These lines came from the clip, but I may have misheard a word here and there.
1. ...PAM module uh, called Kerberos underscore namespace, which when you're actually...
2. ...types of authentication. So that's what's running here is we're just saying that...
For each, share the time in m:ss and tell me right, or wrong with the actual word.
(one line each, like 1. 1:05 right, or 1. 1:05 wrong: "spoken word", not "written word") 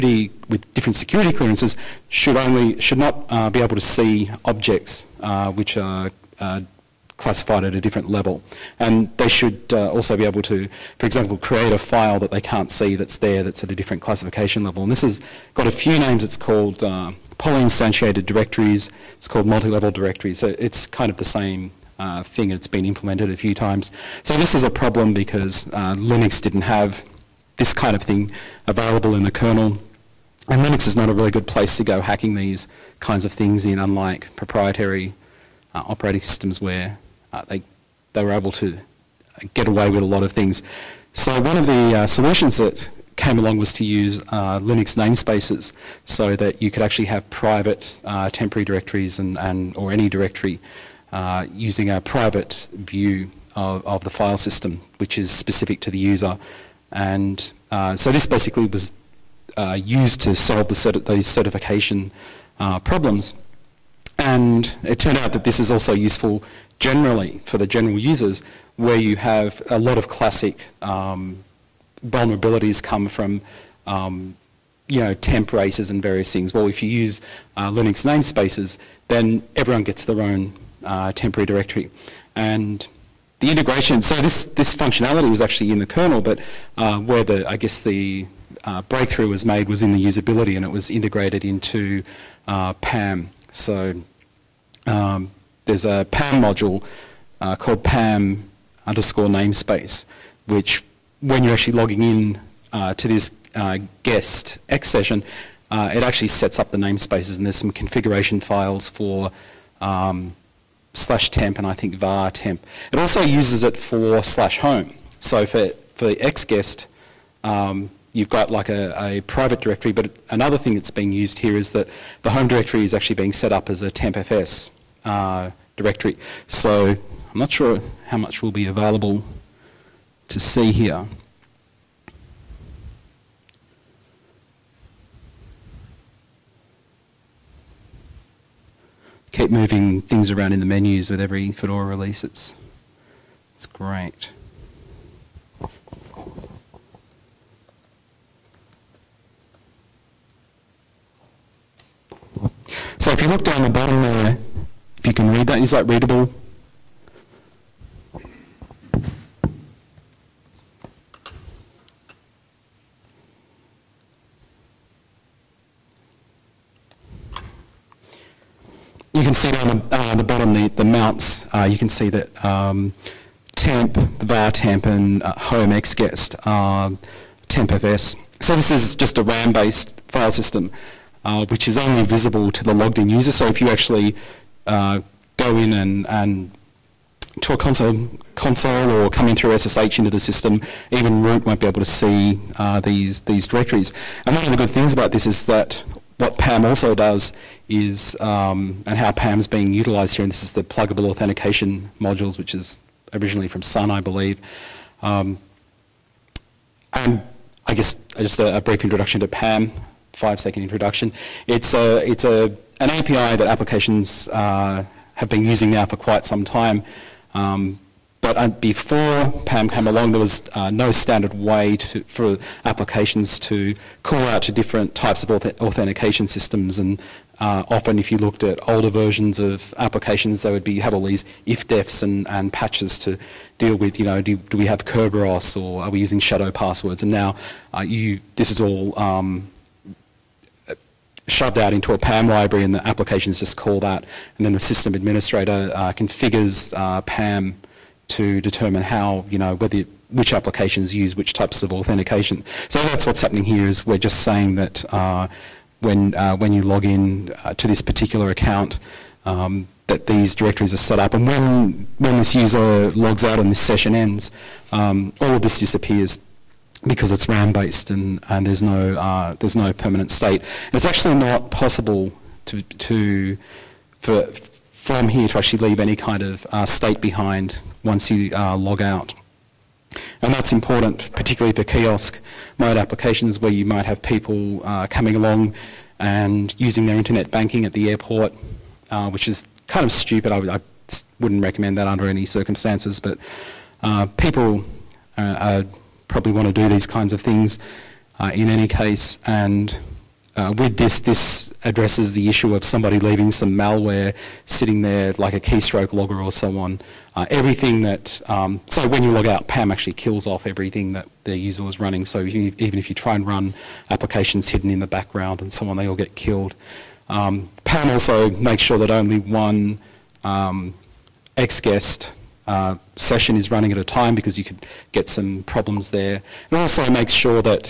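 1. 1:36 wrong: "PAM", not "Kerberos"
2. 4:11 wrong: "happening", not "running".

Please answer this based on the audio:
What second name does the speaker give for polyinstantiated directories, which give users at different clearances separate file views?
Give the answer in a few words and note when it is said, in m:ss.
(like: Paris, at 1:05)
multi-level directories, at 0:19.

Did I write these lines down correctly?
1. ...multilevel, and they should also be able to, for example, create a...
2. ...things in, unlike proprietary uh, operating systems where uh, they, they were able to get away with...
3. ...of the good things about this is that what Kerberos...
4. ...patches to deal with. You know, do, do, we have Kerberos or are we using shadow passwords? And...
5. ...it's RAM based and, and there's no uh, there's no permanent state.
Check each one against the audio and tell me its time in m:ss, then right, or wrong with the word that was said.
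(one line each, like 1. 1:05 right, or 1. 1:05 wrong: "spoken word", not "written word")
1. 0:08 wrong: "level", not "multilevel"
2. 0:33 right
3. 3:14 wrong: "PAM", not "Kerberos"
4. 3:52 right
5. 4:27 right.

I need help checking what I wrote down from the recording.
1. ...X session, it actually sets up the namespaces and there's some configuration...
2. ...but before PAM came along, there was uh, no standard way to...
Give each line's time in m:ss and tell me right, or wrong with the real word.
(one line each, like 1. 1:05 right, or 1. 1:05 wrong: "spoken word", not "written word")
1. 1:44 right
2. 3:38 right.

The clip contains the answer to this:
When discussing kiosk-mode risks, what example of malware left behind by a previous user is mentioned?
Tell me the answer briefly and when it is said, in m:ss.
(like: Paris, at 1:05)
keystroke logger, at 5:05.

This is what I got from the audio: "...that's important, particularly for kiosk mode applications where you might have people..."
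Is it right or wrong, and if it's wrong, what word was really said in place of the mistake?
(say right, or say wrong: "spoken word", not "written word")
right.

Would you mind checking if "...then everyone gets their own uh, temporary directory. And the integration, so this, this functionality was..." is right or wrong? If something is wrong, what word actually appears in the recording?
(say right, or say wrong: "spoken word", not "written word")
right.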